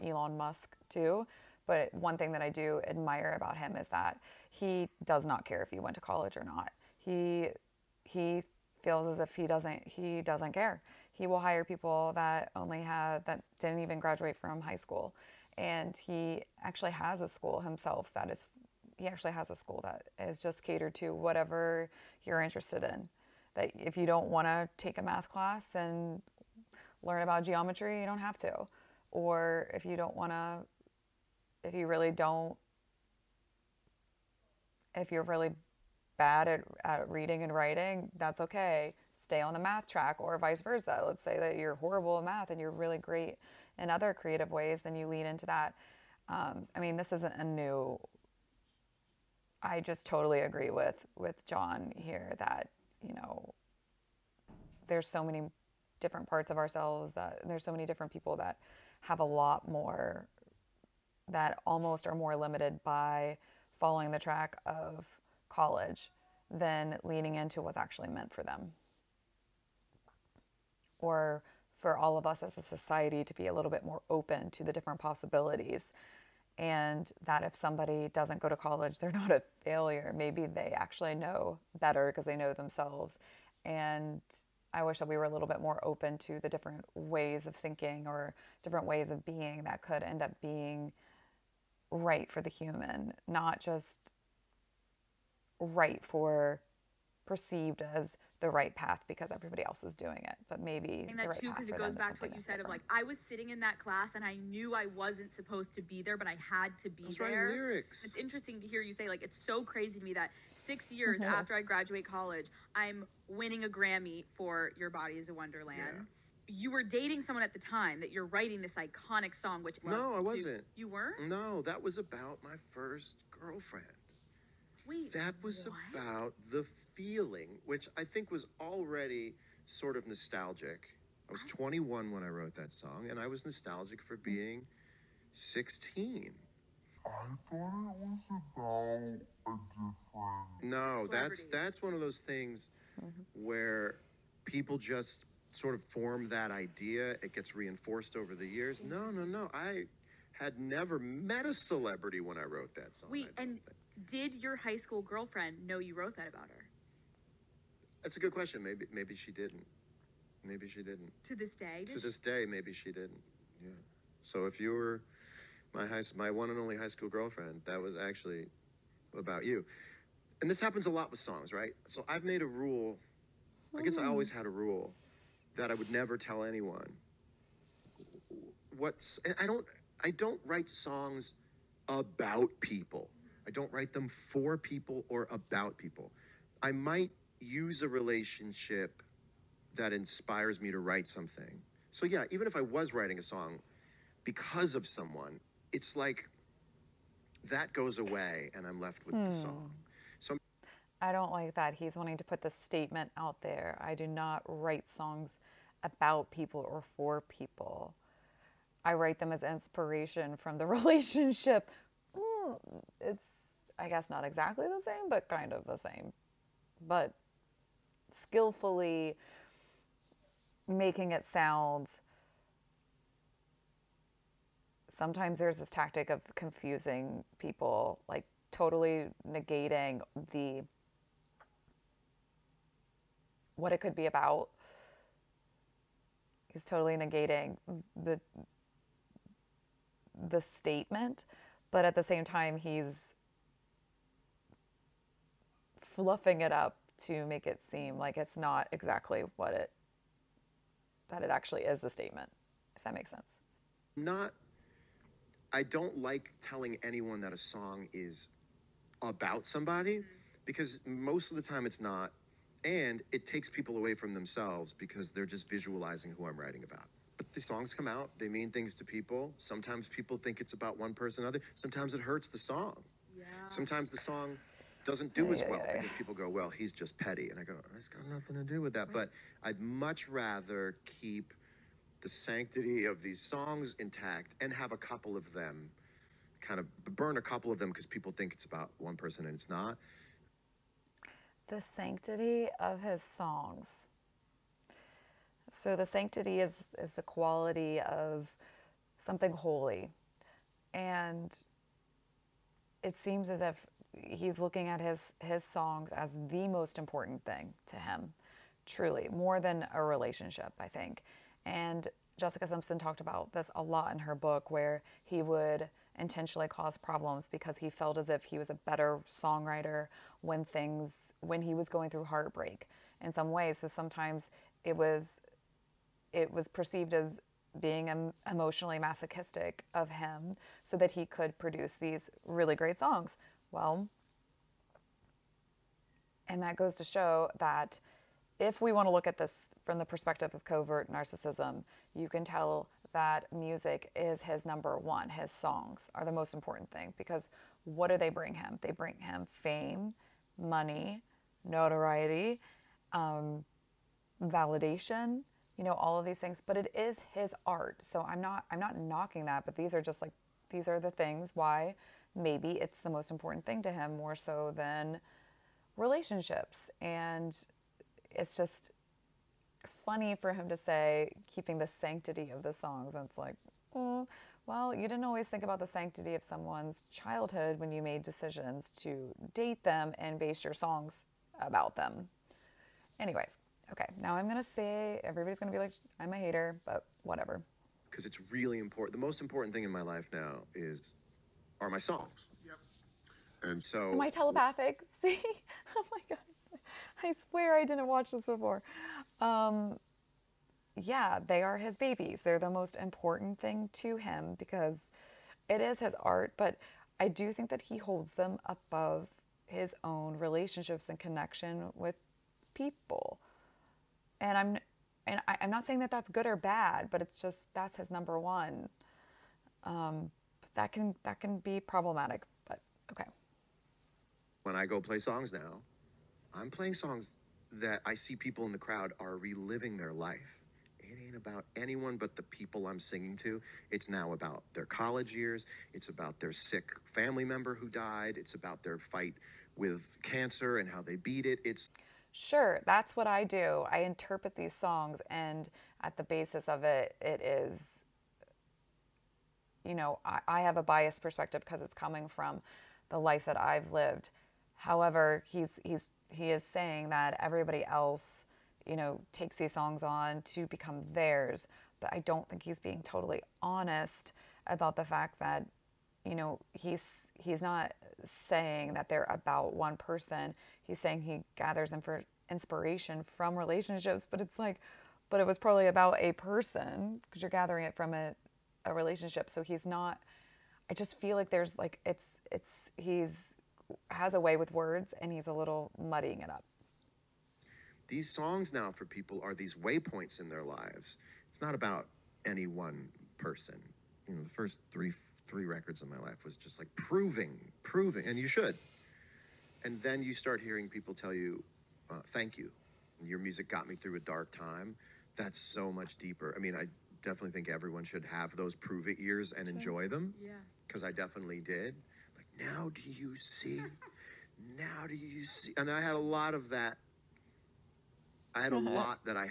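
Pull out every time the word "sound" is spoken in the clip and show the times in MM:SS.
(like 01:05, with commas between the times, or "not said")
03:41.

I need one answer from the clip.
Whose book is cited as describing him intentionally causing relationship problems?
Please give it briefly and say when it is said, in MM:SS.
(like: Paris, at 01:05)
Jessica Simpson, at 05:12.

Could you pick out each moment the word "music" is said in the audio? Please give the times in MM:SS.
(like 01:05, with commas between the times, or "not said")
05:43, 08:23.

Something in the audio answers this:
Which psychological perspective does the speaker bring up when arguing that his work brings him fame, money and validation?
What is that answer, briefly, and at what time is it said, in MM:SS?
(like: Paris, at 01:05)
covert narcissism, at 05:40.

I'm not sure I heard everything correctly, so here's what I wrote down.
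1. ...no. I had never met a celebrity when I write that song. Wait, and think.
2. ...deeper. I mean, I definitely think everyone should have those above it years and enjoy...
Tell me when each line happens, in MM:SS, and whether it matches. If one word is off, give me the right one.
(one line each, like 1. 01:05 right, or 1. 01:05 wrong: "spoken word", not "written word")
1. 02:29 wrong: "wrote", not "write"
2. 08:25 wrong: "prove", not "above".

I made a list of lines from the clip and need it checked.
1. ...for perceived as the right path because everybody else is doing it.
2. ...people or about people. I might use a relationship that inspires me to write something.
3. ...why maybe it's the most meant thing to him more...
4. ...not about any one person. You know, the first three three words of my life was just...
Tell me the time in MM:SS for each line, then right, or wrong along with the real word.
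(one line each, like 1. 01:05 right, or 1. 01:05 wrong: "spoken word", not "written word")
1. 01:36 right
2. 03:04 right
3. 06:01 wrong: "important", not "meant"
4. 08:11 wrong: "records", not "words".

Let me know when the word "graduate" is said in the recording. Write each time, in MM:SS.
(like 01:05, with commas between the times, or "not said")
00:13, 01:51.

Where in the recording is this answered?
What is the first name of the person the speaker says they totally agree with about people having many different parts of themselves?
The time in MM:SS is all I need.
00:51.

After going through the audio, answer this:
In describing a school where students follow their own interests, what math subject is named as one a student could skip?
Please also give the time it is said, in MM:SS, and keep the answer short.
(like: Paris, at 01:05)
geometry, at 00:27.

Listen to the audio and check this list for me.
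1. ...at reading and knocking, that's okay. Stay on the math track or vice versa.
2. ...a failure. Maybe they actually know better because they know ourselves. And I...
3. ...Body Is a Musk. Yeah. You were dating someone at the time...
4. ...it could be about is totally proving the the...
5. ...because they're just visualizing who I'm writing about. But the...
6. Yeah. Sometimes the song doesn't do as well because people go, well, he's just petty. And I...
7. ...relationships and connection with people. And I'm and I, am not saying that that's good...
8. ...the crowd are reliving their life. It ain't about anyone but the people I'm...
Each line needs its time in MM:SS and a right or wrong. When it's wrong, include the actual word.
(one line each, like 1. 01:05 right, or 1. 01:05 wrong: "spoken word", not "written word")
1. 00:36 wrong: "writing", not "knocking"
2. 01:19 wrong: "themselves", not "ourselves"
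3. 01:54 wrong: "Wonderland", not "Musk"
4. 03:53 wrong: "negating", not "proving"
5. 04:24 right
6. 04:33 right
7. 06:50 right
8. 07:08 right.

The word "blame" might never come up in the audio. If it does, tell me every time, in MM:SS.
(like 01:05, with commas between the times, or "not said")
not said.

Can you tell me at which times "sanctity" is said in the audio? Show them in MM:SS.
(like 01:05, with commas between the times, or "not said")
04:42, 04:51, 04:55, 06:11, 06:15.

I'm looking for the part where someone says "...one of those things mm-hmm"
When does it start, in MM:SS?
02:21.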